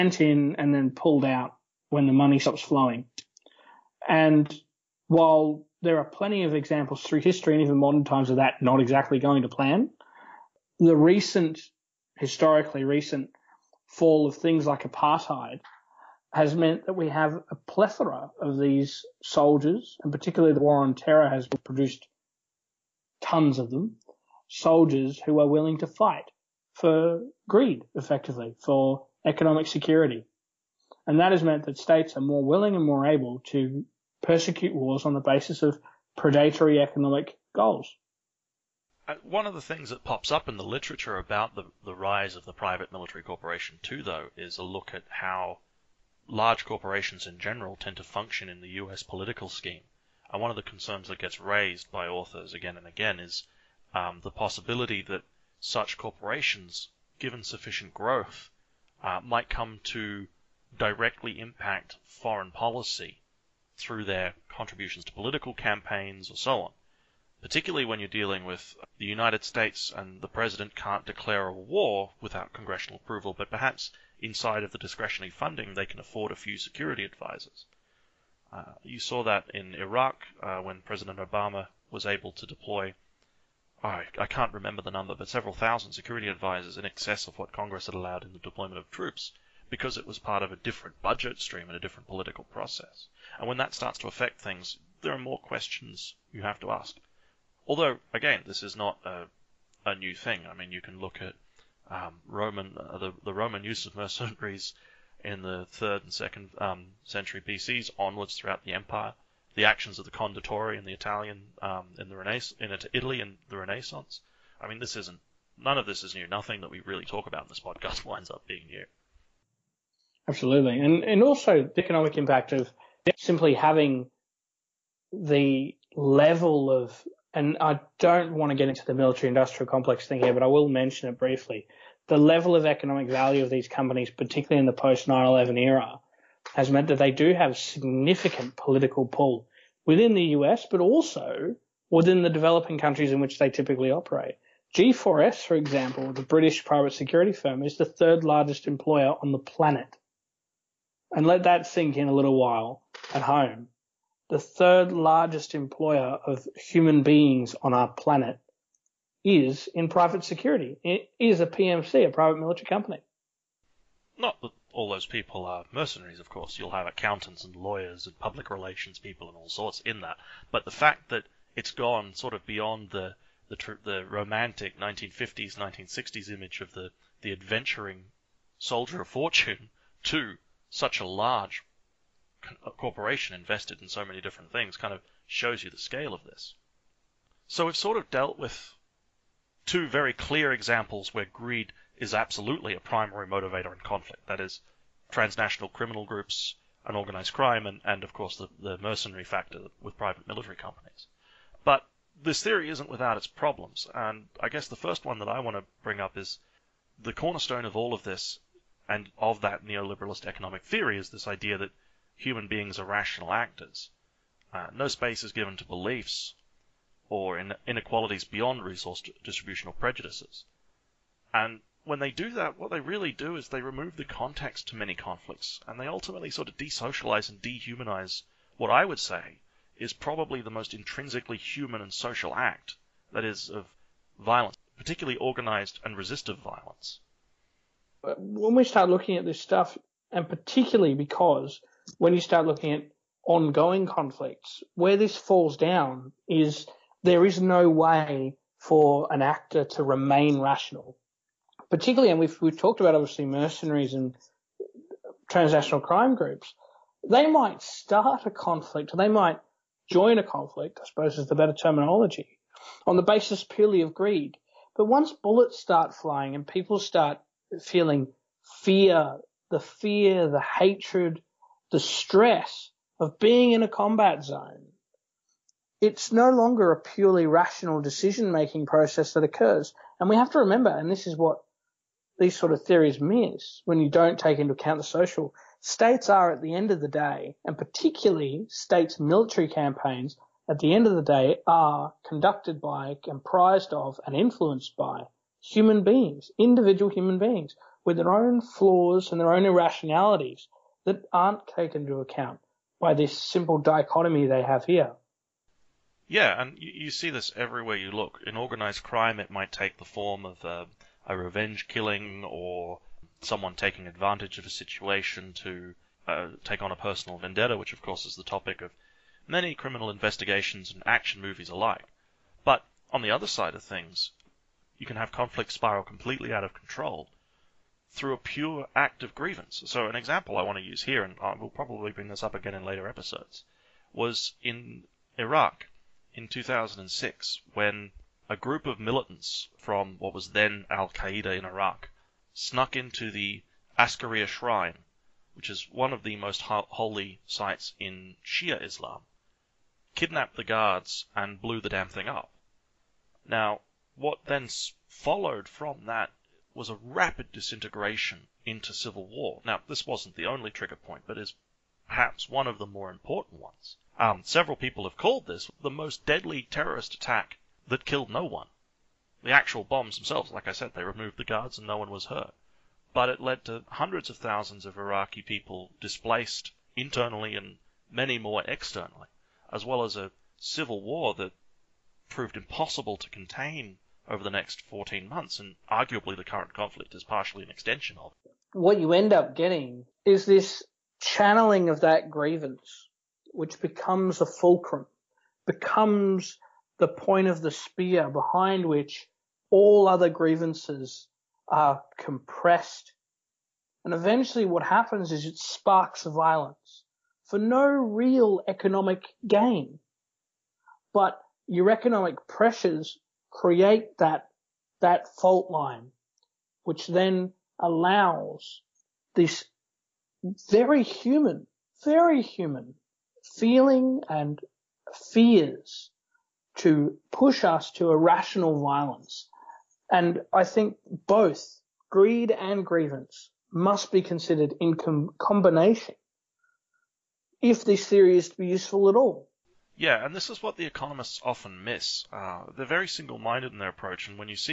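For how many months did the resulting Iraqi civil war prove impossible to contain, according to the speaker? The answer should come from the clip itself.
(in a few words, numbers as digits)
14.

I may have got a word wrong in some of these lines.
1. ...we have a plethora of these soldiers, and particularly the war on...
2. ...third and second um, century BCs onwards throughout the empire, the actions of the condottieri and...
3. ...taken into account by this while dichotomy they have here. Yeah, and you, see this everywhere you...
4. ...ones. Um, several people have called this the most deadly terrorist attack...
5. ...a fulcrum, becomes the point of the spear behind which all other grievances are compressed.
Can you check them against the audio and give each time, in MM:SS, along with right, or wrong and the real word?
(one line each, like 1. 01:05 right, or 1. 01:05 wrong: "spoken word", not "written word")
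1. 00:16 right
2. 01:45 right
3. 05:01 wrong: "simple", not "while"
4. 06:03 right
5. 06:34 right.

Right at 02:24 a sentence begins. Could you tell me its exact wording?
G4S, for example, the British private security firm, is the third largest employer on the planet.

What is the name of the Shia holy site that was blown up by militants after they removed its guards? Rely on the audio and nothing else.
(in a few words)
Askaria Shrine.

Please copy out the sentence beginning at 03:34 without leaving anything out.
Uh, no space is given to beliefs or in inequalities beyond resource distributional prejudices.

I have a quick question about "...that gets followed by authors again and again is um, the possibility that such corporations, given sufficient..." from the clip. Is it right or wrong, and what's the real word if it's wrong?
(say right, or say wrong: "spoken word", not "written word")
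wrong: "raised", not "followed".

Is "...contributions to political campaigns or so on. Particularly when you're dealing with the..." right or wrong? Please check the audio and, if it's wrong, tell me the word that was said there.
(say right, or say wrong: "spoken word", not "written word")
right.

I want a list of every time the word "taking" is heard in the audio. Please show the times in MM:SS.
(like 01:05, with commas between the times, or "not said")
05:13.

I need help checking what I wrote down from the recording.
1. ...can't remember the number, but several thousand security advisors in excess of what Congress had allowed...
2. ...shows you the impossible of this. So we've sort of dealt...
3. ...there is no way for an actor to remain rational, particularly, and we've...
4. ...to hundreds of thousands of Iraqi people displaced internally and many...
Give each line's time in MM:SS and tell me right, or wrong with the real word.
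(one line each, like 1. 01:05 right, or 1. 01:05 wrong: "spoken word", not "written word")
1. 01:24 right
2. 03:05 wrong: "scale", not "impossible"
3. 04:07 right
4. 06:13 right.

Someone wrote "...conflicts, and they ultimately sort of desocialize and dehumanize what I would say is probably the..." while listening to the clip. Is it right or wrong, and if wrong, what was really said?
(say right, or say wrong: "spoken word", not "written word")
right.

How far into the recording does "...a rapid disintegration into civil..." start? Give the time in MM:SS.
05:56.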